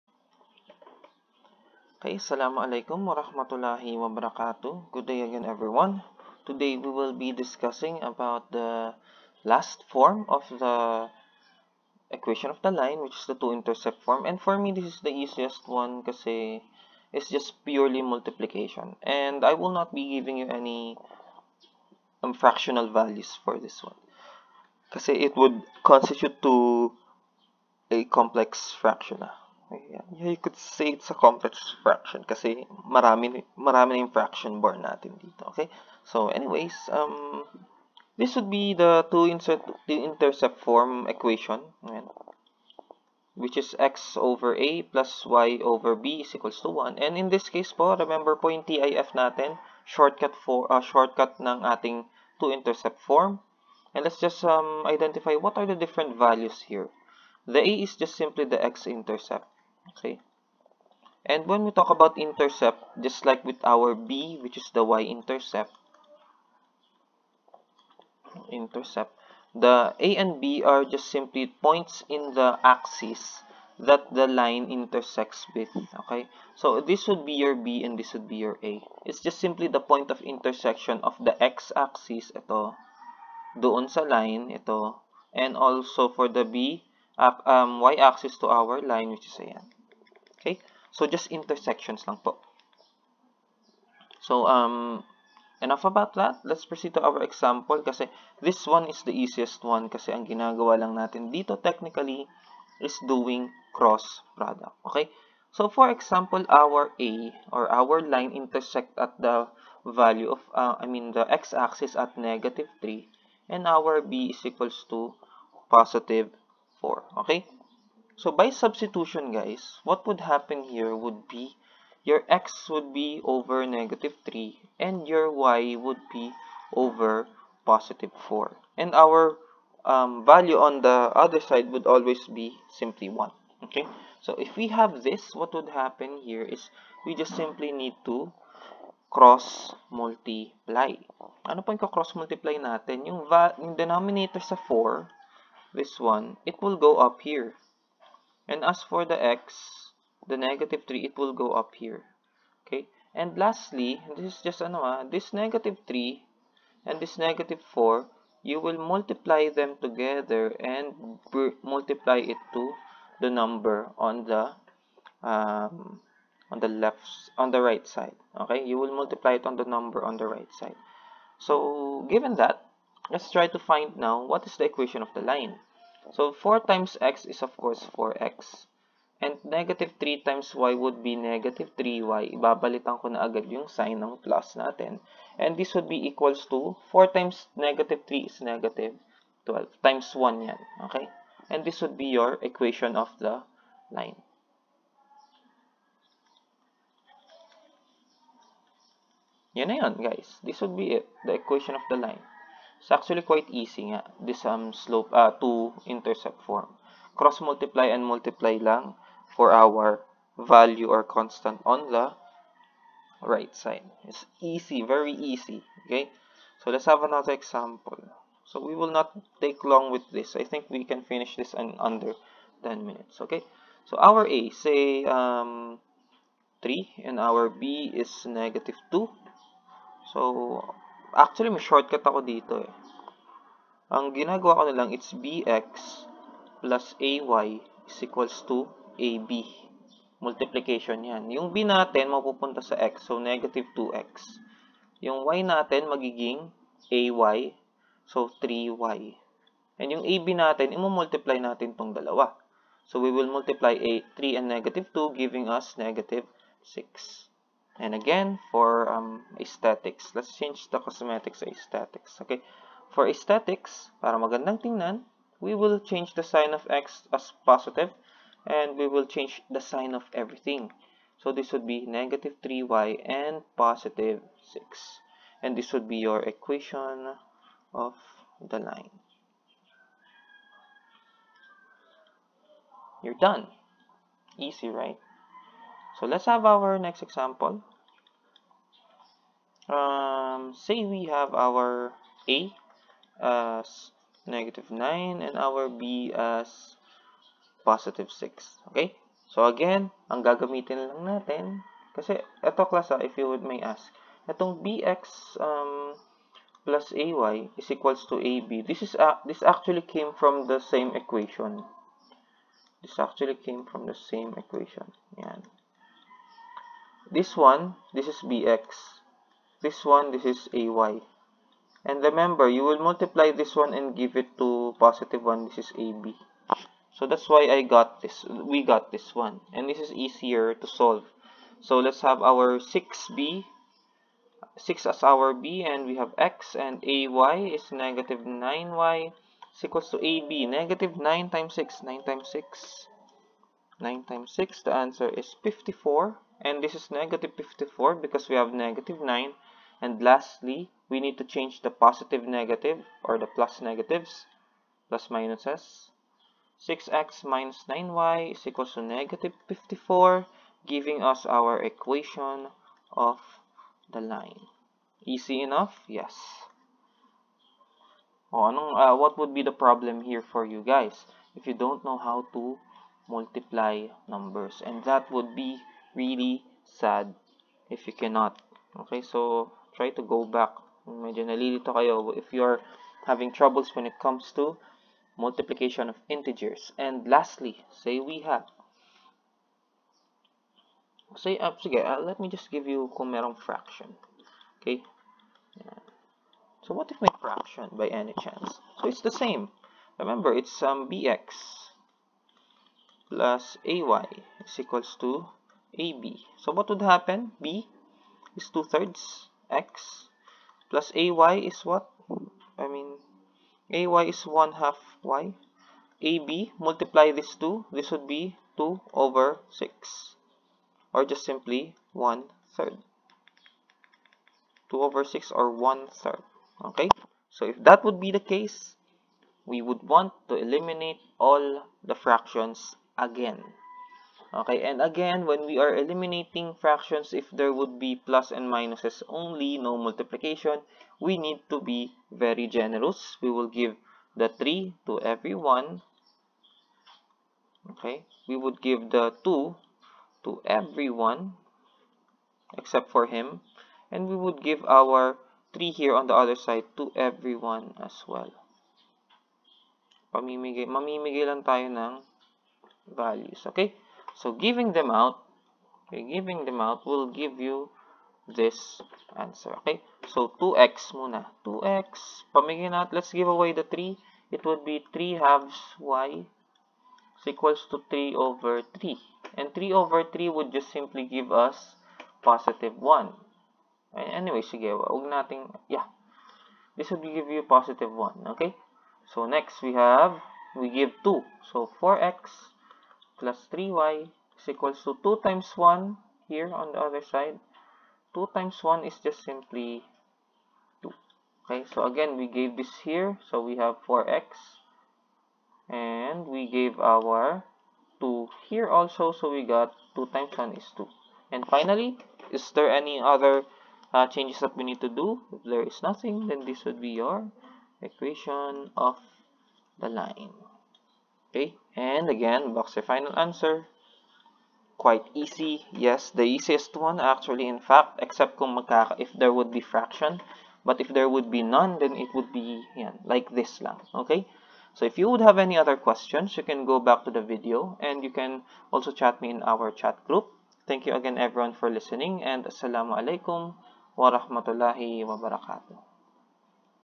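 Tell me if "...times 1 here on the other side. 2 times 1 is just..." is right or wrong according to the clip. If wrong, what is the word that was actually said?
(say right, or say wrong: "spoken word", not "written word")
right.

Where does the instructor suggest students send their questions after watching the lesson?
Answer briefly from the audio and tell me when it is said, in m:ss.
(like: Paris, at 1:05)
chat group, at 8:59.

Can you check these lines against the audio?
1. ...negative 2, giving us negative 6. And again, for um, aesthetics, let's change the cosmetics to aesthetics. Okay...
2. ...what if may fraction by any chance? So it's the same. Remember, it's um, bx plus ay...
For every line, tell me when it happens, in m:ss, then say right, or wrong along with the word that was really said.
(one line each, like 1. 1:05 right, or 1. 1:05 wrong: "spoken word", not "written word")
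1. 4:14 right
2. 6:36 right.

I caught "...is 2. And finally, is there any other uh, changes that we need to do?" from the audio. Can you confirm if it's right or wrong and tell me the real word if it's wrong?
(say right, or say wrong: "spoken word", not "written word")
right.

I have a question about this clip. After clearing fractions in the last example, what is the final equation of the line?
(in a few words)
4x + 3y = 2.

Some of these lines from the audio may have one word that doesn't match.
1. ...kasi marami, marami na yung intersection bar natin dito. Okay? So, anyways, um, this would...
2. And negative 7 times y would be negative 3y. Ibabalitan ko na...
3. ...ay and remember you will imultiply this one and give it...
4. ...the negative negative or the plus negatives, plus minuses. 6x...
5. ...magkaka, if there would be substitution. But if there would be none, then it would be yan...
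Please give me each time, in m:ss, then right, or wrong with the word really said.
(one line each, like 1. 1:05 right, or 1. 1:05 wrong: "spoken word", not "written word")
1. 0:32 wrong: "fraction", not "intersection"
2. 2:59 wrong: "3", not "7"
3. 5:20 wrong: "multiply", not "imultiply"
4. 5:51 wrong: "positive", not "negative"
5. 8:48 wrong: "fraction", not "substitution".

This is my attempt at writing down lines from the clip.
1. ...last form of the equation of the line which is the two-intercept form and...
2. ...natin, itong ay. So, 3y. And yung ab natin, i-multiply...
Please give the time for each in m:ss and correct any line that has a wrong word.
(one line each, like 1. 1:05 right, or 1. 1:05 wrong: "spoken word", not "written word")
1. 0:09 right
2. 4:05 wrong: "magiging", not "itong".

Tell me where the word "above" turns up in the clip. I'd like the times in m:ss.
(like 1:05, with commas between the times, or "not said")
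not said.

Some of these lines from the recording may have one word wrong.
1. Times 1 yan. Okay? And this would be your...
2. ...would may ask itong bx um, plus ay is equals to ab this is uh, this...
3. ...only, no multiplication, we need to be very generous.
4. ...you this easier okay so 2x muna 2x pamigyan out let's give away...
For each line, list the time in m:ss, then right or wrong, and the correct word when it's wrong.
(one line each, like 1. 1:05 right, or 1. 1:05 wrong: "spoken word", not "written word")
1. 3:09 right
2. 5:03 right
3. 7:19 right
4. 7:47 wrong: "answer", not "easier".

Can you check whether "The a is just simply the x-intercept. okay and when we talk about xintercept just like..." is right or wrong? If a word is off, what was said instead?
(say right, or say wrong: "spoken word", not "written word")
wrong: "intercept", not "xintercept".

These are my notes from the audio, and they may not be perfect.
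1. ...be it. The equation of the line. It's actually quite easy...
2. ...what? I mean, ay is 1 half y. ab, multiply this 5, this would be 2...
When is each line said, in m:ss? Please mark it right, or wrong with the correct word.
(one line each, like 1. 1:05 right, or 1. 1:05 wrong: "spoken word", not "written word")
1. 3:20 right
2. 6:51 wrong: "2", not "5".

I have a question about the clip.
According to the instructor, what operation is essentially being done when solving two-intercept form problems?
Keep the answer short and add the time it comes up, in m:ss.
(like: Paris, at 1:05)
cross product, at 1:43.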